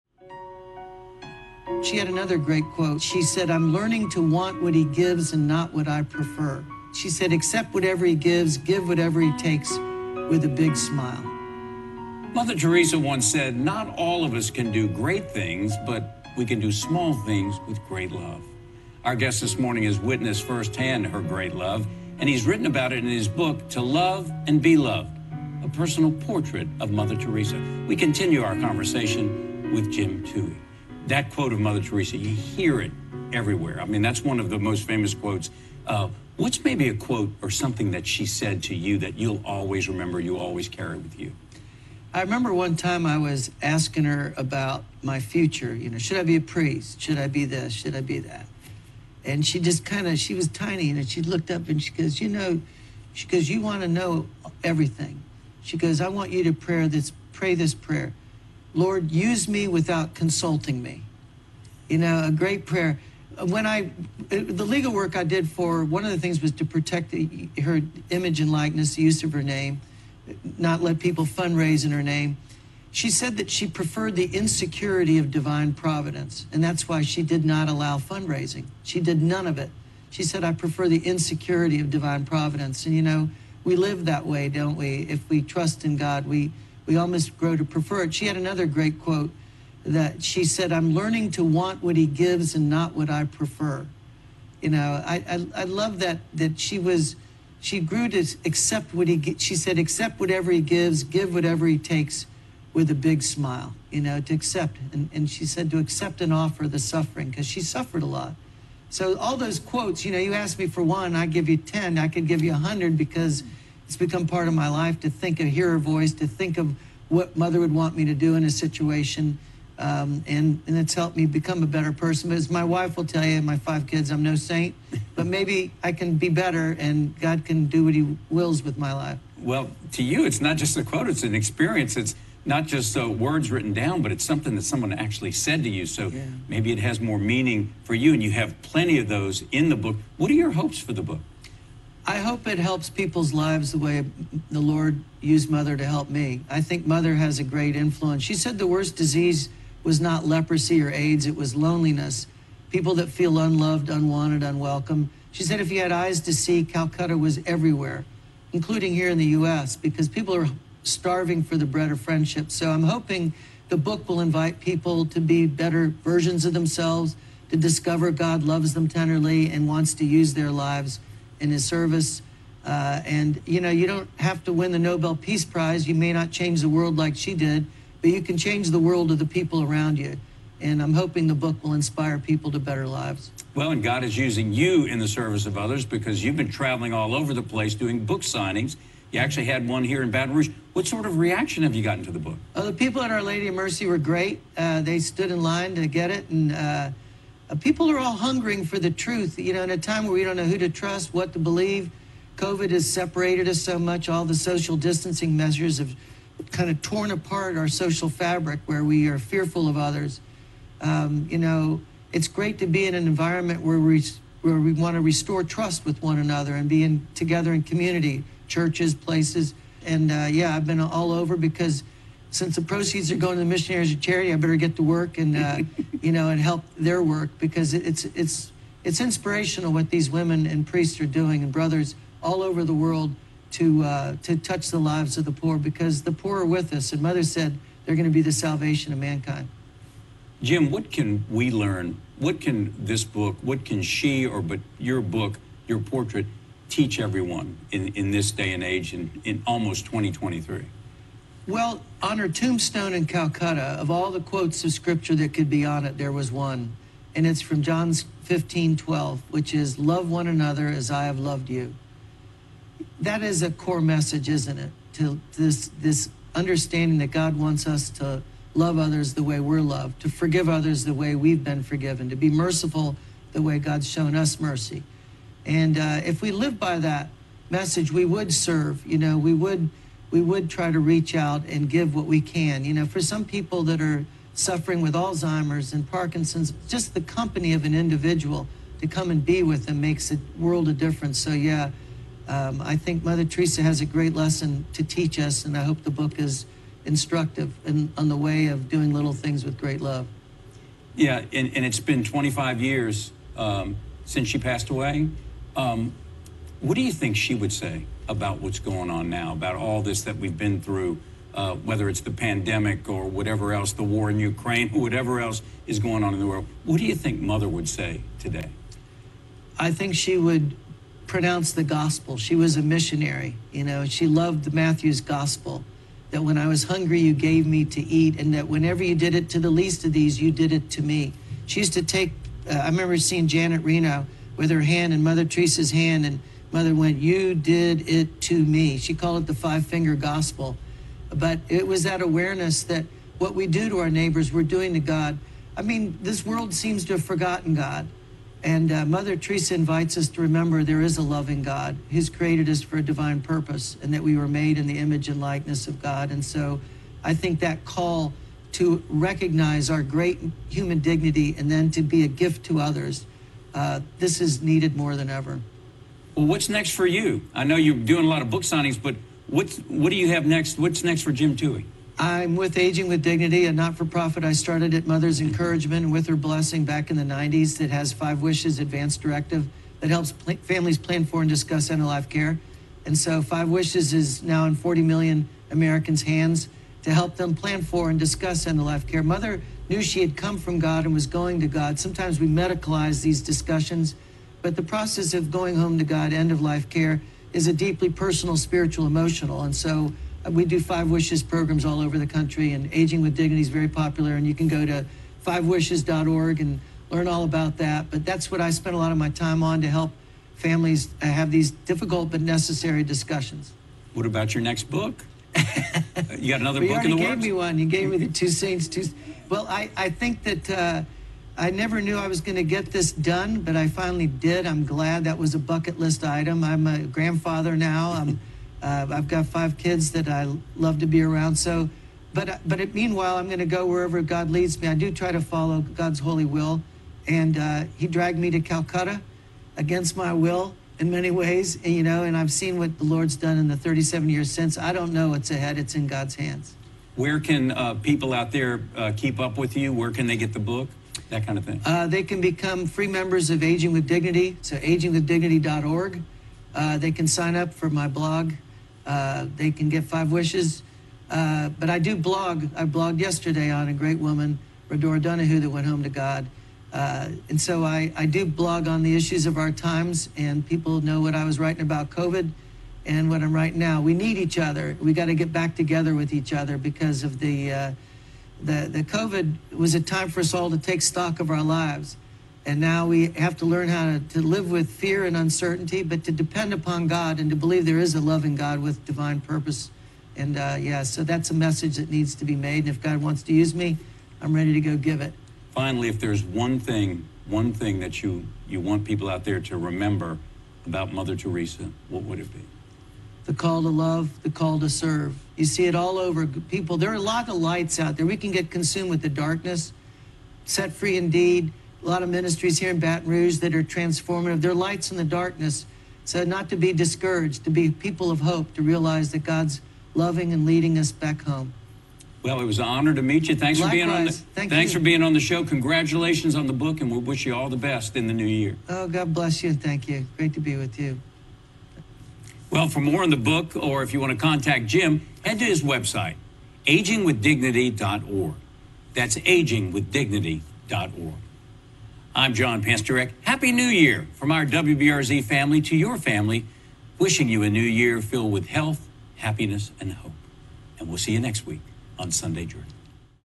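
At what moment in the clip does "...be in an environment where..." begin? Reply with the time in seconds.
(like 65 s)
212 s.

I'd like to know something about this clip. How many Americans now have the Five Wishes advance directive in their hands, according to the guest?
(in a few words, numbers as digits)
40 million.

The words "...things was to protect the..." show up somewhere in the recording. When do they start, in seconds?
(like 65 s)
66 s.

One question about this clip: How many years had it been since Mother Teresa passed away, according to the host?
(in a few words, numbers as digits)
25 years.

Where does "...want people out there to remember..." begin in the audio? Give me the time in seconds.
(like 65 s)
498 s.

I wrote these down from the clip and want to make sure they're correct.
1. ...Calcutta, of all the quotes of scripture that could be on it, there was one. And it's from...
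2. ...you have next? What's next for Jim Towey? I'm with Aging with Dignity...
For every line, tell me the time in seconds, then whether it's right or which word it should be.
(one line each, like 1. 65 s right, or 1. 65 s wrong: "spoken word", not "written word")
1. 253 s right
2. 369 s right.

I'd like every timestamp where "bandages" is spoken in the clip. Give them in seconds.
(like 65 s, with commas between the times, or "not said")
not said.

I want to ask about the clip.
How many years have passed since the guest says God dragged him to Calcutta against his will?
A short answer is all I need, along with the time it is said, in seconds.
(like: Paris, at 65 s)
37, at 443 s.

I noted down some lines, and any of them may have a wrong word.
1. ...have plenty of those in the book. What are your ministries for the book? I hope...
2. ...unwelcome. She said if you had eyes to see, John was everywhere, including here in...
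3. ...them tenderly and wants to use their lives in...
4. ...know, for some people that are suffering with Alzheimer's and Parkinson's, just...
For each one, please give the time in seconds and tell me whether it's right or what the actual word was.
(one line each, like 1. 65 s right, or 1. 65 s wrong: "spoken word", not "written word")
1. 138 s wrong: "hopes", not "ministries"
2. 154 s wrong: "Calcutta", not "John"
3. 168 s right
4. 282 s right.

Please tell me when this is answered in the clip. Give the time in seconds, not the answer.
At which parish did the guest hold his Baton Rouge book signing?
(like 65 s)
193 s.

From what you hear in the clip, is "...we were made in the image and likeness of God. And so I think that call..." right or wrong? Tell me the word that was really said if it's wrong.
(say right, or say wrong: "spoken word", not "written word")
right.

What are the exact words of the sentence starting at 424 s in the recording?
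I'm glad that was a bucket list item.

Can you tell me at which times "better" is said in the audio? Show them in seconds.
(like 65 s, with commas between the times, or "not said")
121 s, 126 s, 165 s, 182 s, 224 s.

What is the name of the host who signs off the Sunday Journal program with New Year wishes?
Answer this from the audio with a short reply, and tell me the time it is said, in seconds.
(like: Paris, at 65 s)
John Pastorek, at 542 s.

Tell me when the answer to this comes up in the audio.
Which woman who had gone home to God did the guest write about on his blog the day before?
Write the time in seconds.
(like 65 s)
464 s.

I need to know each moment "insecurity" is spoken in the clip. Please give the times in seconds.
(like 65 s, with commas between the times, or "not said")
74 s, 81 s.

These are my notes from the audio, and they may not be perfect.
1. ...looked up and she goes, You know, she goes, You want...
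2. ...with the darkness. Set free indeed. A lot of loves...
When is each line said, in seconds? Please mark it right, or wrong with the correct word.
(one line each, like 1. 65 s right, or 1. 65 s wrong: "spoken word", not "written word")
1. 51 s right
2. 508 s wrong: "ministries", not "loves".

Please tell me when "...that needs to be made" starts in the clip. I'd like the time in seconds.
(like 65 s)
491 s.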